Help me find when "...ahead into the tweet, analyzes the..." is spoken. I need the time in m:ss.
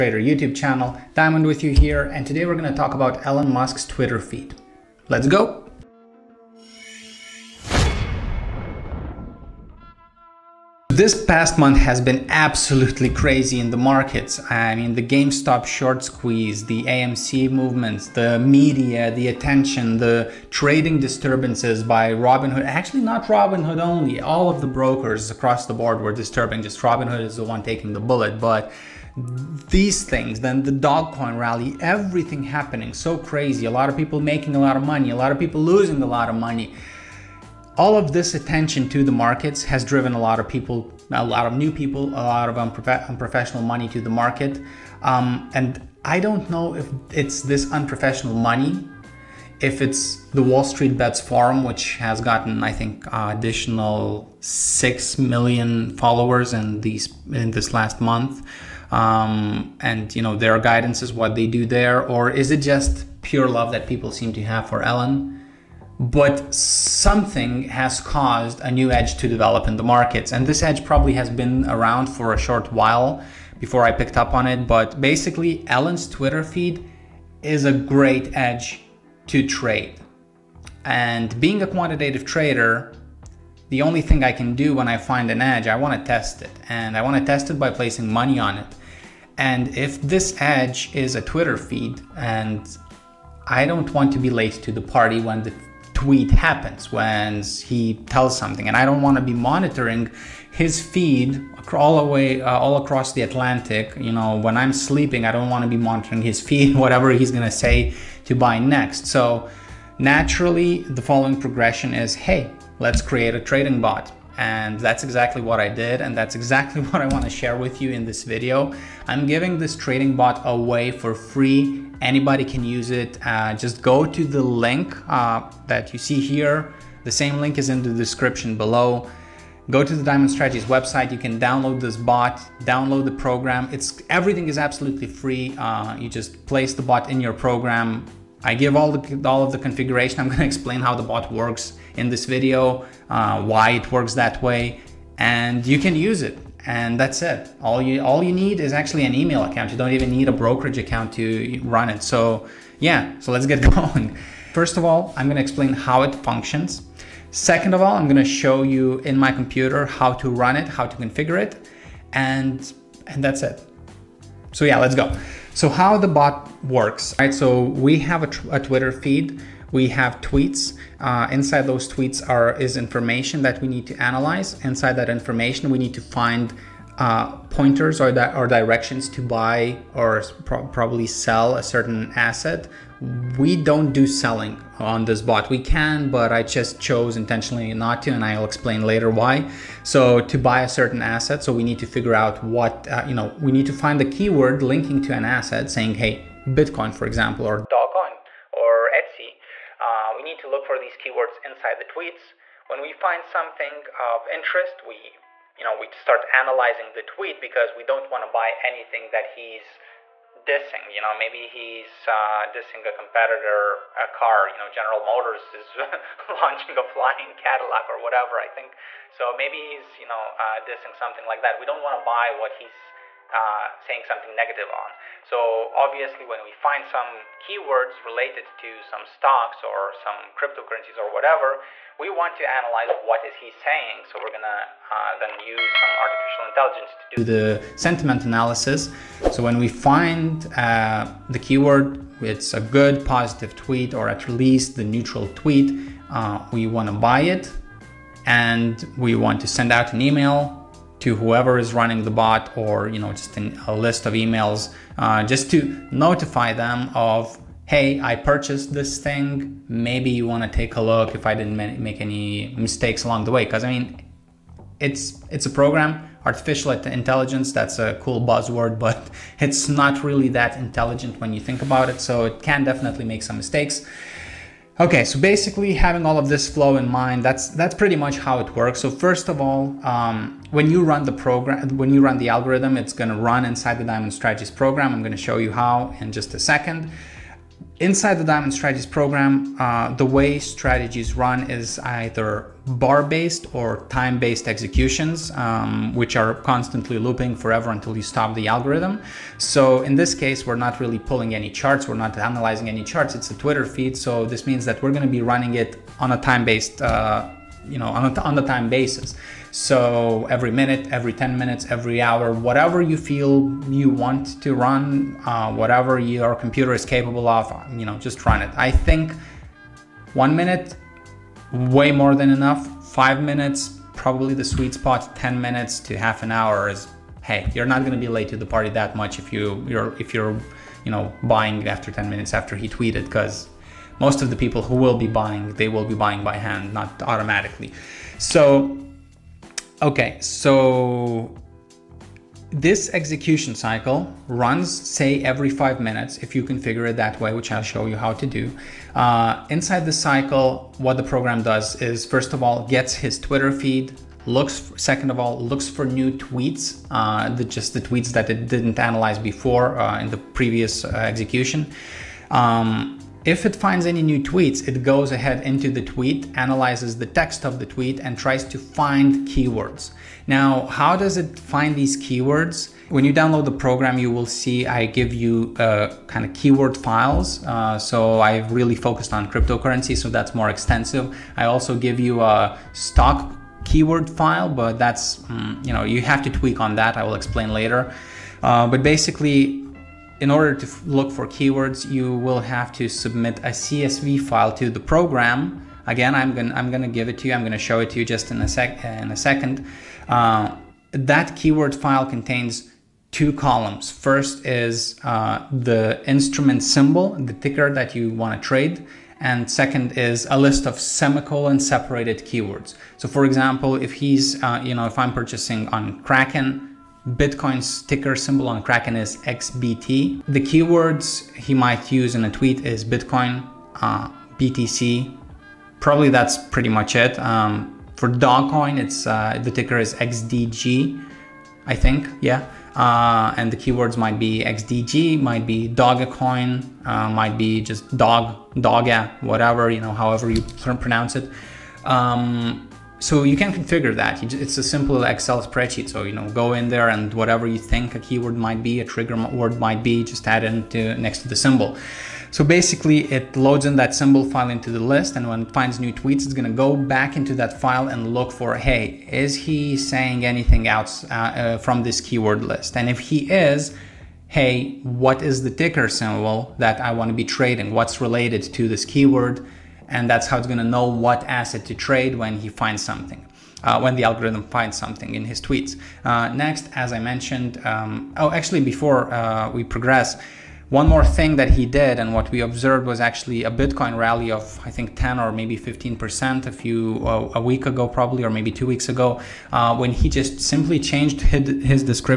6:05.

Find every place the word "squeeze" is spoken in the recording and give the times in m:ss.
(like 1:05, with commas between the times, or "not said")
0:16.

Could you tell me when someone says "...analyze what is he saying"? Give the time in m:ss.
3:52.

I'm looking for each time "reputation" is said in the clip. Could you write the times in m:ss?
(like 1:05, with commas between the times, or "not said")
not said.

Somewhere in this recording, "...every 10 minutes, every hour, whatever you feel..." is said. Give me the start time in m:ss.
5:10.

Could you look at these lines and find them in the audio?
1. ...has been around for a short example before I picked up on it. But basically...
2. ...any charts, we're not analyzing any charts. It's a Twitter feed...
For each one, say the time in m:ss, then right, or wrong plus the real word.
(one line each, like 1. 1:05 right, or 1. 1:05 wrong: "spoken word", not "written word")
1. 1:11 wrong: "while", not "example"
2. 5:01 right.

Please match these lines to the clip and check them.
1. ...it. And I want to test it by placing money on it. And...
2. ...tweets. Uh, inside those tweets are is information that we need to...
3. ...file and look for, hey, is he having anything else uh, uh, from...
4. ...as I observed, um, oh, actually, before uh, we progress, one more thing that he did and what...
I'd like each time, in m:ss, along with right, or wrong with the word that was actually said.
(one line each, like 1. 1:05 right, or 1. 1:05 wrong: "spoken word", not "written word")
1. 1:26 right
2. 2:50 right
3. 7:37 wrong: "saying", not "having"
4. 7:56 wrong: "mentioned", not "observed".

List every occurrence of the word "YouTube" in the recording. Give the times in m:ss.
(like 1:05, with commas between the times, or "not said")
0:00.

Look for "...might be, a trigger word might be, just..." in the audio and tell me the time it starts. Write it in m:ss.
7:28.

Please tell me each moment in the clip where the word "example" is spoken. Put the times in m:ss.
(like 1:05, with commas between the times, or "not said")
3:17, 6:53.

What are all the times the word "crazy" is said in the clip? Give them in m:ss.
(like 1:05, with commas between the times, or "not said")
0:13, 0:33.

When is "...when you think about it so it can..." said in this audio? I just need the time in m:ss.
4:31.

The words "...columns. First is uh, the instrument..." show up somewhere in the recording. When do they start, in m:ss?
6:43.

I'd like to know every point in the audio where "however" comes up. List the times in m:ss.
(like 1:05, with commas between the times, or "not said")
7:19.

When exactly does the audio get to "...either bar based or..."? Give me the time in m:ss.
4:51.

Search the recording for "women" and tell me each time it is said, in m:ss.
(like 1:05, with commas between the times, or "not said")
not said.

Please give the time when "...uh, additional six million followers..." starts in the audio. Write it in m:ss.
0:53.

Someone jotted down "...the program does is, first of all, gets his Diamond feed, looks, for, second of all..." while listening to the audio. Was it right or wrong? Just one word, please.
wrong.